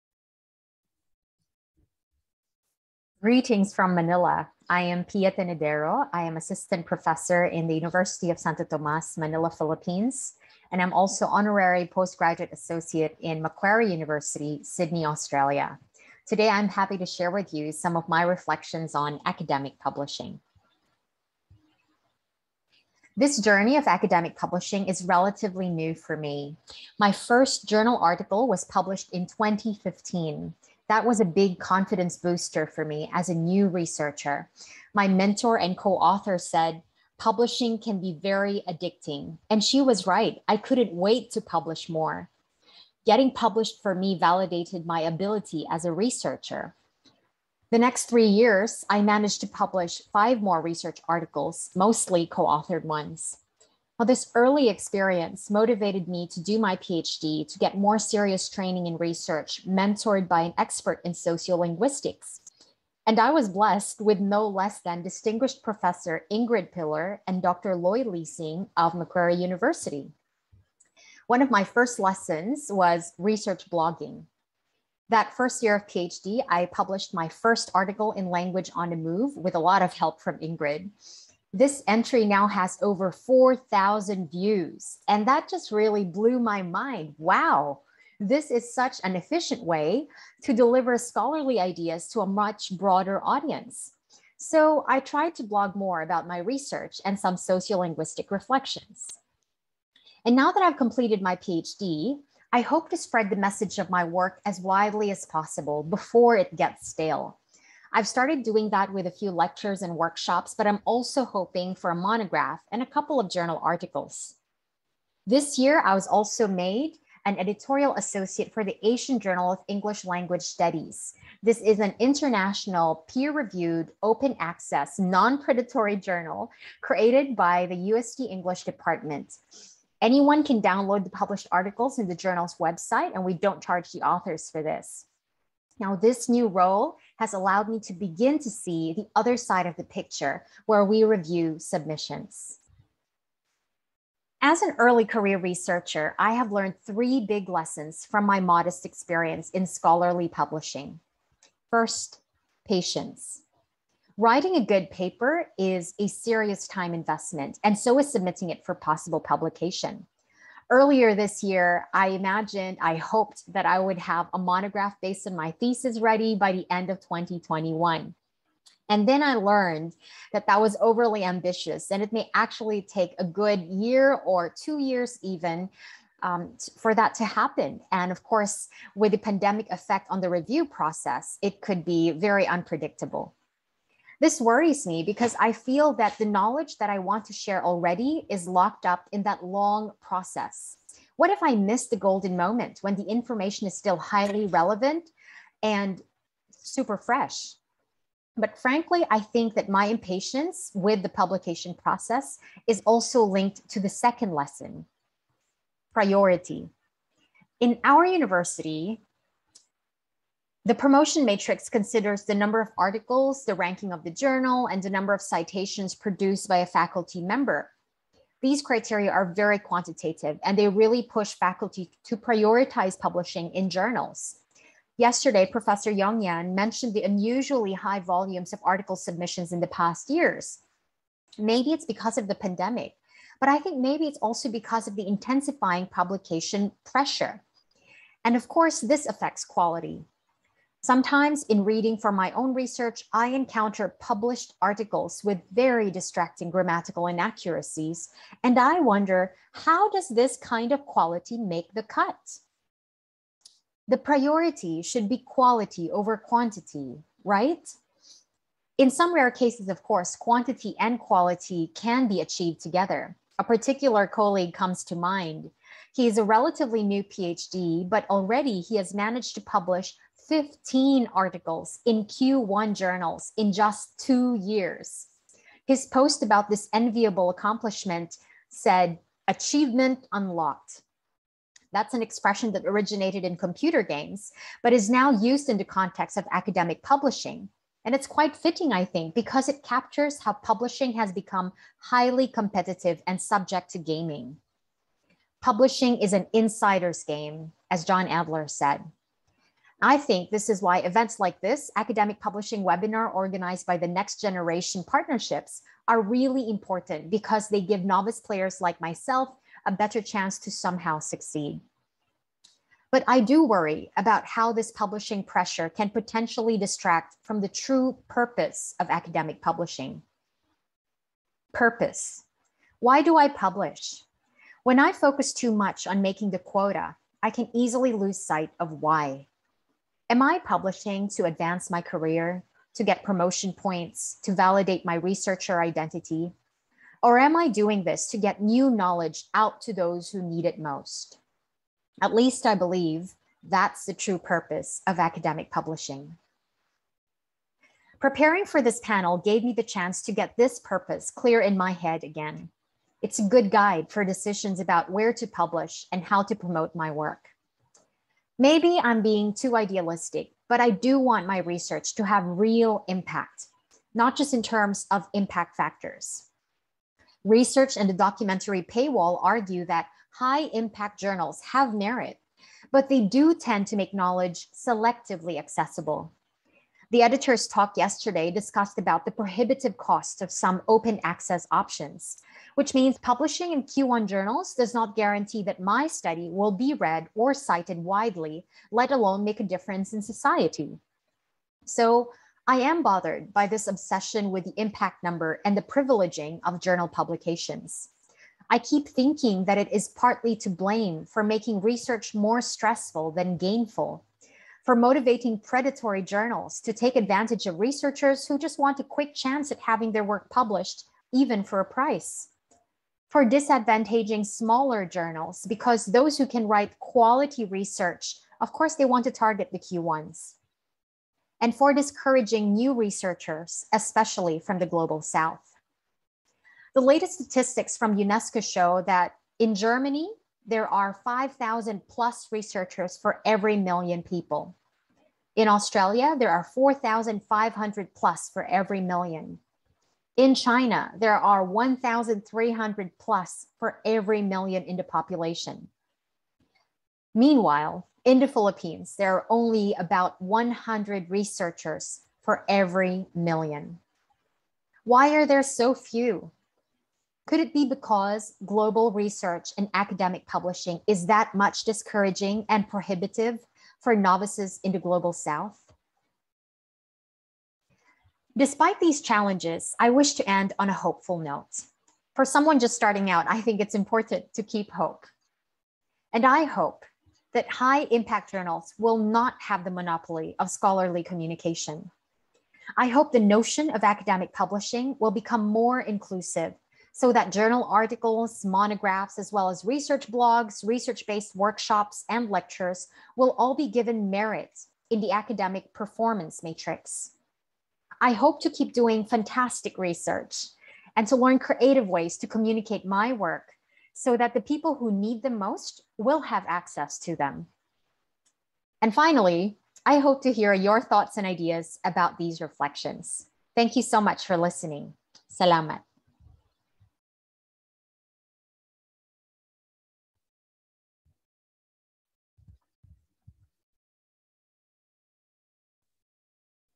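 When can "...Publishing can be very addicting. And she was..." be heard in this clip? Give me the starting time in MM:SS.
00:37.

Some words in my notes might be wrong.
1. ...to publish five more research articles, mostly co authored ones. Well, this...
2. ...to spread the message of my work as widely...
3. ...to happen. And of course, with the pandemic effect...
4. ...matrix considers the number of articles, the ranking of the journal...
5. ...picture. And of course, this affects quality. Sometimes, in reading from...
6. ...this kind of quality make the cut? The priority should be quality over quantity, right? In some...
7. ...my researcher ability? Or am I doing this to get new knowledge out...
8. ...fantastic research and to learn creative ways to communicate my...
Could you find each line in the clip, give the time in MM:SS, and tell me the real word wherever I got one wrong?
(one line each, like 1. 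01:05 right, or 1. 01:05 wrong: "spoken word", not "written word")
1. 00:49 right
2. 01:42 right
3. 02:57 right
4. 03:31 right
5. 03:56 wrong: "pressure", not "picture"
6. 04:10 right
7. 05:34 wrong: "identity", not "ability"
8. 08:19 right.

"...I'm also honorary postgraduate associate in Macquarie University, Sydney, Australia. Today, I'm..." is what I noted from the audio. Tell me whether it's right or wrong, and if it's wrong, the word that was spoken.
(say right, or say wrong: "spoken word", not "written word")
right.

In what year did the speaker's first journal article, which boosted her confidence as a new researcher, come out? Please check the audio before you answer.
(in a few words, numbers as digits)
2015.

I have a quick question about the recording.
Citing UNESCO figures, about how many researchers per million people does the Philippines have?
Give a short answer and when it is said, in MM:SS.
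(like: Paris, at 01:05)
about 100, at 07:29.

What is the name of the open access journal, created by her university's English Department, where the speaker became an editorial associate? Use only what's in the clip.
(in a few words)
Asian Journal of English Language Studies.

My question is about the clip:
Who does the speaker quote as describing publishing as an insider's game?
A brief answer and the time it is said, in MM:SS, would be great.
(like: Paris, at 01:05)
John Adler, at 04:57.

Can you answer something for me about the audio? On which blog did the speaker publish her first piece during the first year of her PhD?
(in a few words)
Language on the Move.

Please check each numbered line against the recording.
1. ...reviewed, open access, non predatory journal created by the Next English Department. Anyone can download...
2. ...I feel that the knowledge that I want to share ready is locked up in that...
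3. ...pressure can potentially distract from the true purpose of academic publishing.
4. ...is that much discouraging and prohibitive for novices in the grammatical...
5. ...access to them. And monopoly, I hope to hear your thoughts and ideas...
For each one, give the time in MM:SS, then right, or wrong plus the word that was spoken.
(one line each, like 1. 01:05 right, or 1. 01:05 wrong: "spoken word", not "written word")
1. 02:03 wrong: "UST", not "Next"
2. 03:05 wrong: "already", not "ready"
3. 05:15 right
4. 07:40 wrong: "global", not "grammatical"
5. 08:26 wrong: "finally", not "monopoly".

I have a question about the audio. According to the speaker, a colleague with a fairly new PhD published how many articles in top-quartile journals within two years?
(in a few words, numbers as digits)
15.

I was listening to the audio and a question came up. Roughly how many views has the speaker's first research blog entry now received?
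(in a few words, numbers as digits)
over 4,000.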